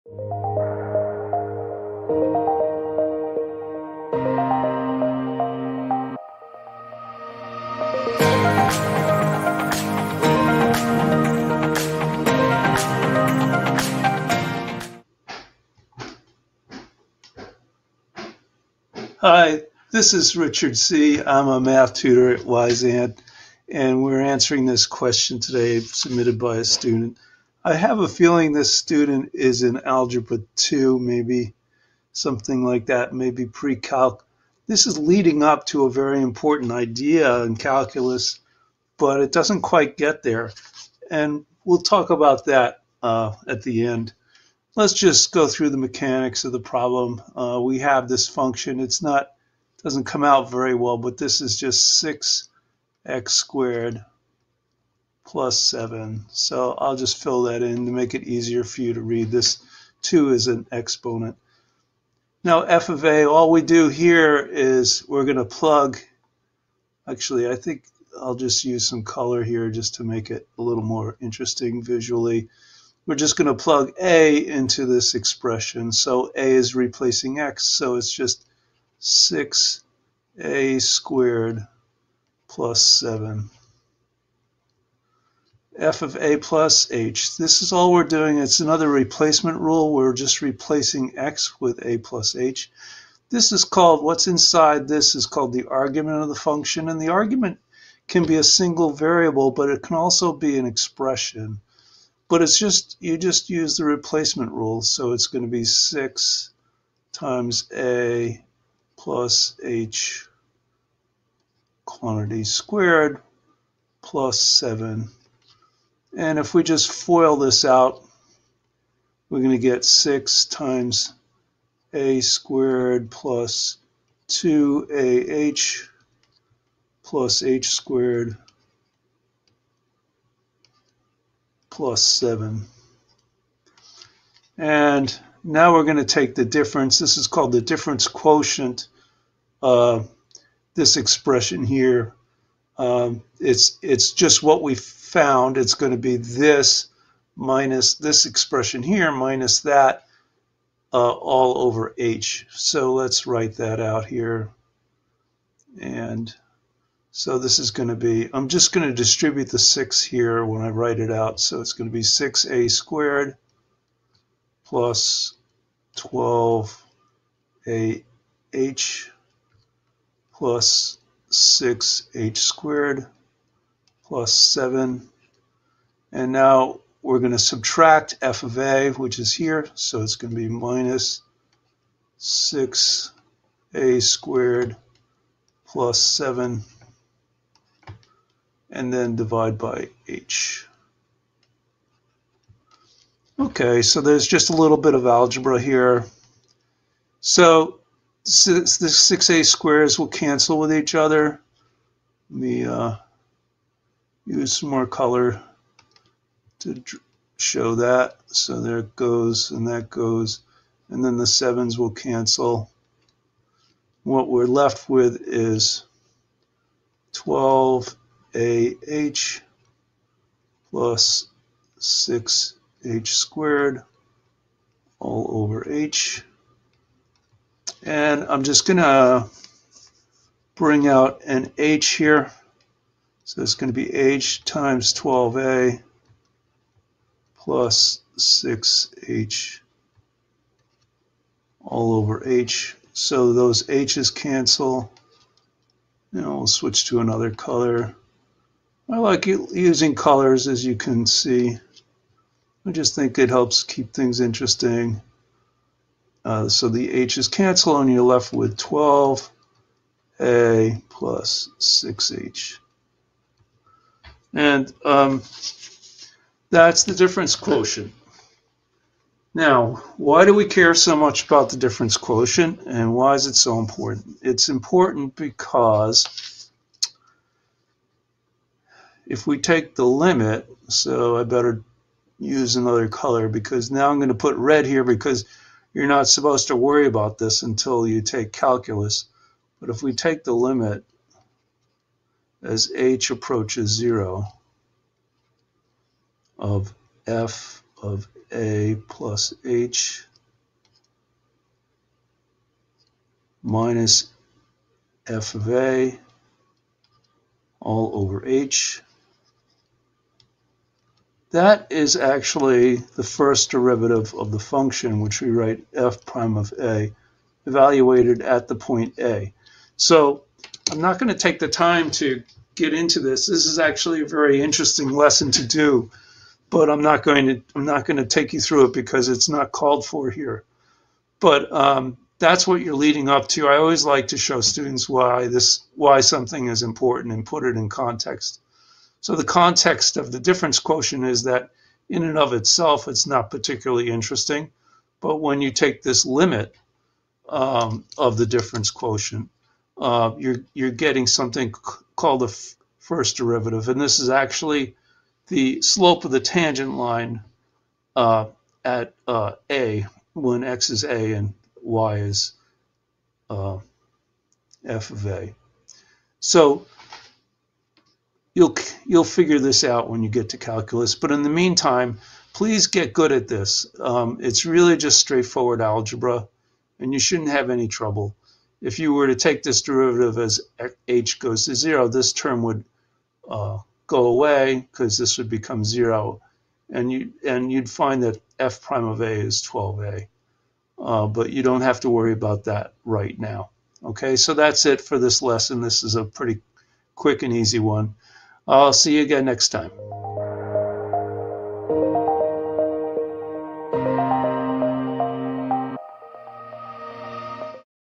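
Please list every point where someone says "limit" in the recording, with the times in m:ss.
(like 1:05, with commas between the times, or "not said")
4:39, 4:50, 5:46.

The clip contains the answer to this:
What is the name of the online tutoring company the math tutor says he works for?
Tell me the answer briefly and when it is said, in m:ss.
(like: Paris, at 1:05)
Wyzant, at 0:22.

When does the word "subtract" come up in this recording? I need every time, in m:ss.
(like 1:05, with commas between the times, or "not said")
2:57.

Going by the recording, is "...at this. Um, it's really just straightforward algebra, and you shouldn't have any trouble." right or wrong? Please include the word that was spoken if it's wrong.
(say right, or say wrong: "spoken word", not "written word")
right.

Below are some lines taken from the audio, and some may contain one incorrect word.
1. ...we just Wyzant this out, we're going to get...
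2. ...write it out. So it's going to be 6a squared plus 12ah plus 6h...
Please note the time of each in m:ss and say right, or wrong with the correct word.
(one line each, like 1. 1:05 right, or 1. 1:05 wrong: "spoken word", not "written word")
1. 1:56 wrong: "FOIL", not "Wyzant"
2. 2:40 right.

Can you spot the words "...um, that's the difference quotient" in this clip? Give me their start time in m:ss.
4:24.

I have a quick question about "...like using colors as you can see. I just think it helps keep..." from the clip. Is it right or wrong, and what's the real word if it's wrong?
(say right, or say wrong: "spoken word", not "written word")
right.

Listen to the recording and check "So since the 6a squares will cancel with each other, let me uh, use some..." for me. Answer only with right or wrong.
right.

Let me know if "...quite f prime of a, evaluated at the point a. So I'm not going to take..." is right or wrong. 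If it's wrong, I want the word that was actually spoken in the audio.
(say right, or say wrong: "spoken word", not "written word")
wrong: "write", not "quite".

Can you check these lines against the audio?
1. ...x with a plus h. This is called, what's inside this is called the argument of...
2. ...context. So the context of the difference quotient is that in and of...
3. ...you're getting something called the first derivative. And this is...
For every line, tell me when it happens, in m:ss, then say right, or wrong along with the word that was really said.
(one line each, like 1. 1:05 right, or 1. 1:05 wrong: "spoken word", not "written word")
1. 1:31 right
2. 5:37 right
3. 5:50 right.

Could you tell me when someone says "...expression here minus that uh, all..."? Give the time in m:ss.
2:28.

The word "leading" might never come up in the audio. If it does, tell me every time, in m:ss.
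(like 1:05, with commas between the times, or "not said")
0:34, 5:32.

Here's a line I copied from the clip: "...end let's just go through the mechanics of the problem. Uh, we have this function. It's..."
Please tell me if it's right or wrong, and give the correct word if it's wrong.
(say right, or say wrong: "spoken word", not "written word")
right.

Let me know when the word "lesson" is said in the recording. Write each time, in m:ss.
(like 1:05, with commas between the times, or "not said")
5:24, 6:35.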